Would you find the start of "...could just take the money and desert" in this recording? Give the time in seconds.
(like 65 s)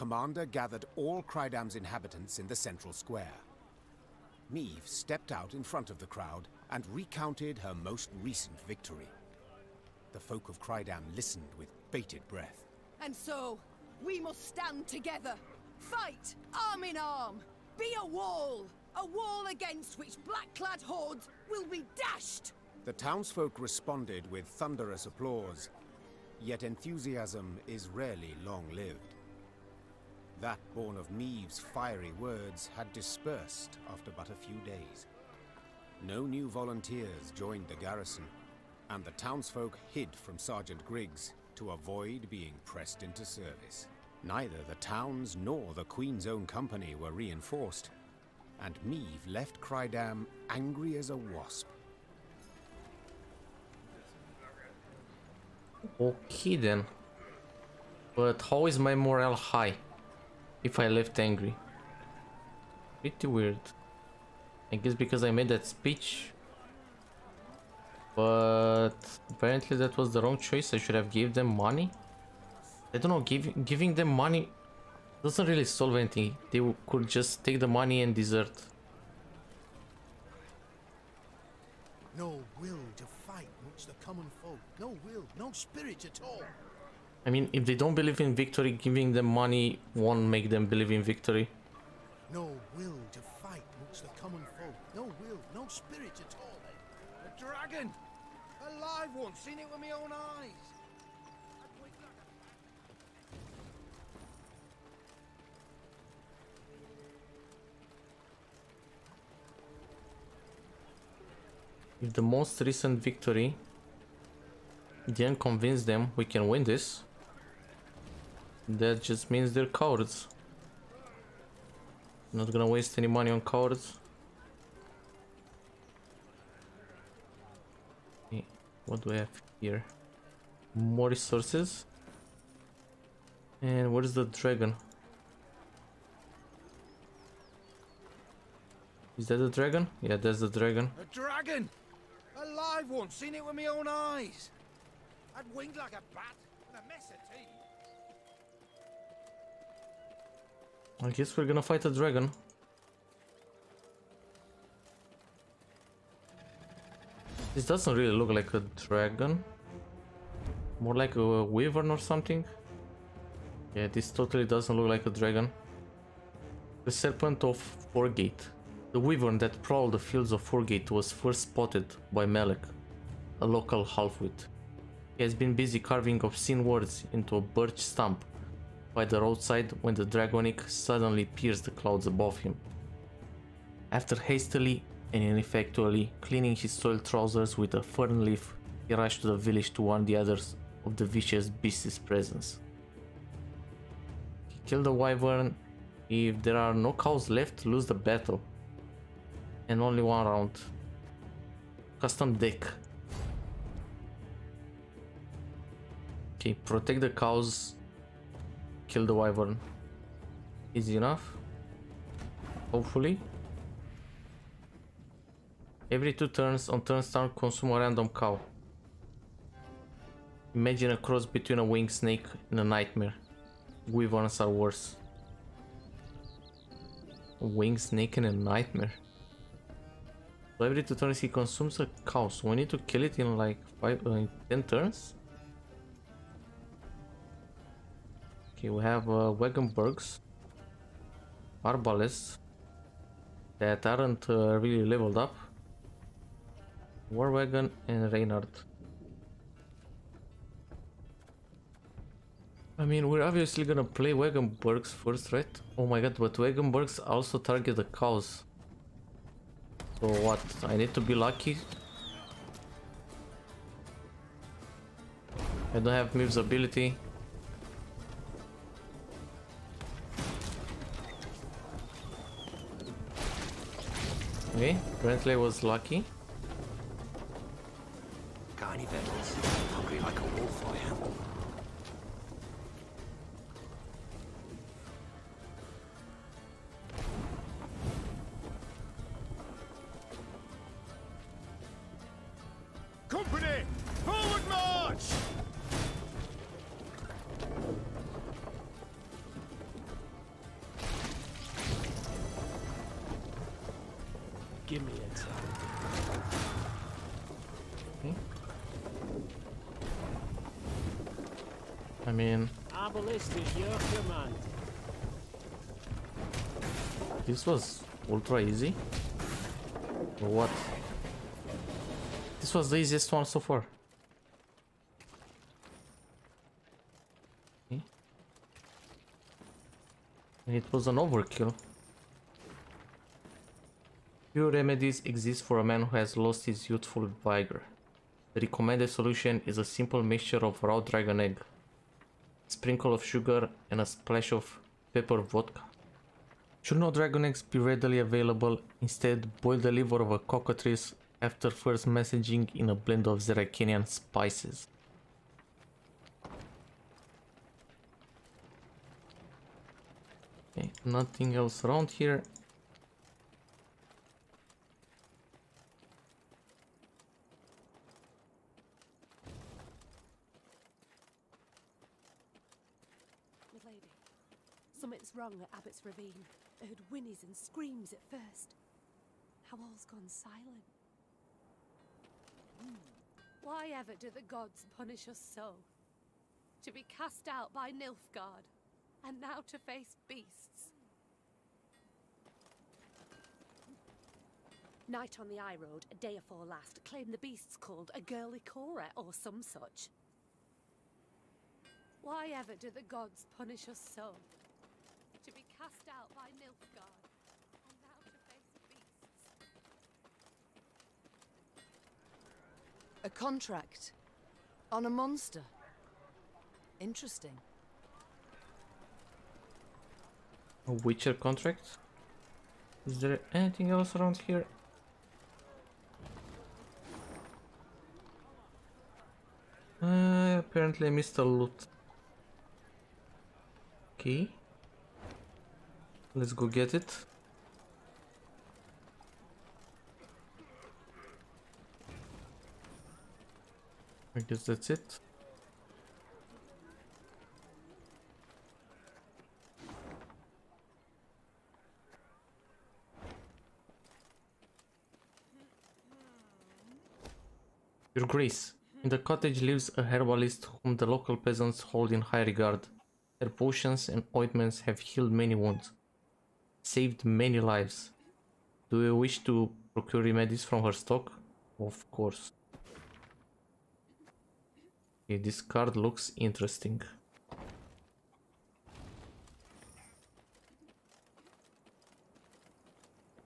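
76 s.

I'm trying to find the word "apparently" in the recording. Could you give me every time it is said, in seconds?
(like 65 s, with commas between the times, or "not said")
69 s, 274 s, 430 s.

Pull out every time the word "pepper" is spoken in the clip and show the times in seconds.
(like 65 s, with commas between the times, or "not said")
344 s.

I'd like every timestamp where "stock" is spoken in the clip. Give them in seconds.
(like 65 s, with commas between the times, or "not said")
470 s.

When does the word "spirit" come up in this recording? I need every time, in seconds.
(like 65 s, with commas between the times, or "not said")
85 s, 95 s.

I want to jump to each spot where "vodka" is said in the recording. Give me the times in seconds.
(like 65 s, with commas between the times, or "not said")
345 s.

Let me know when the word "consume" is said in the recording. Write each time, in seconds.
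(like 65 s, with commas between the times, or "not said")
217 s, 231 s.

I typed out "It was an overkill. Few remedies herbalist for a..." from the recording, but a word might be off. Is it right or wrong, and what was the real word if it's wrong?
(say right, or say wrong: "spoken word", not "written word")
wrong: "exist", not "herbalist".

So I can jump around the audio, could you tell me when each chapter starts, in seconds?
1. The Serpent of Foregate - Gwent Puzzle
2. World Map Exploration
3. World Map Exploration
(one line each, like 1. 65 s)
1. 159 s
2. 322 s
3. 52 s.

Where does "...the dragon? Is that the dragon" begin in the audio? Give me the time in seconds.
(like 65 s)
134 s.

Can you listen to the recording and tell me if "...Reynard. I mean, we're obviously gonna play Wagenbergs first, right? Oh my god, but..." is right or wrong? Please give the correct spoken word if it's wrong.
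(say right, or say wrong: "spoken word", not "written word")
right.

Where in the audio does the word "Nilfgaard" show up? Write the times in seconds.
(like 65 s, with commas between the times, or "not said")
387 s, 406 s.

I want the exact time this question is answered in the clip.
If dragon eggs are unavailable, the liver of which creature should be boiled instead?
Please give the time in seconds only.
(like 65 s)
350 s.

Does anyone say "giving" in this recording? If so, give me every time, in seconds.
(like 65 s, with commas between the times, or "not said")
73 s, 88 s.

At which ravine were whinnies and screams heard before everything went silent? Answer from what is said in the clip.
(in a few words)
Abbott's Ravine.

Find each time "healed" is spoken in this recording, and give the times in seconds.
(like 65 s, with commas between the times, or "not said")
464 s.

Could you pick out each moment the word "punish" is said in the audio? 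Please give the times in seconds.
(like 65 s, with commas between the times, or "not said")
384 s, 403 s.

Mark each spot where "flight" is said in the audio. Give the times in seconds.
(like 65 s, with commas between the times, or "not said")
not said.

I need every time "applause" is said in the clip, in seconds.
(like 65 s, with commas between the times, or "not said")
25 s.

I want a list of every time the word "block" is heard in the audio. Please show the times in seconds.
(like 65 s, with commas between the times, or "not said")
not said.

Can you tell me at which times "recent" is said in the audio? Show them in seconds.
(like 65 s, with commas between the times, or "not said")
8 s, 112 s.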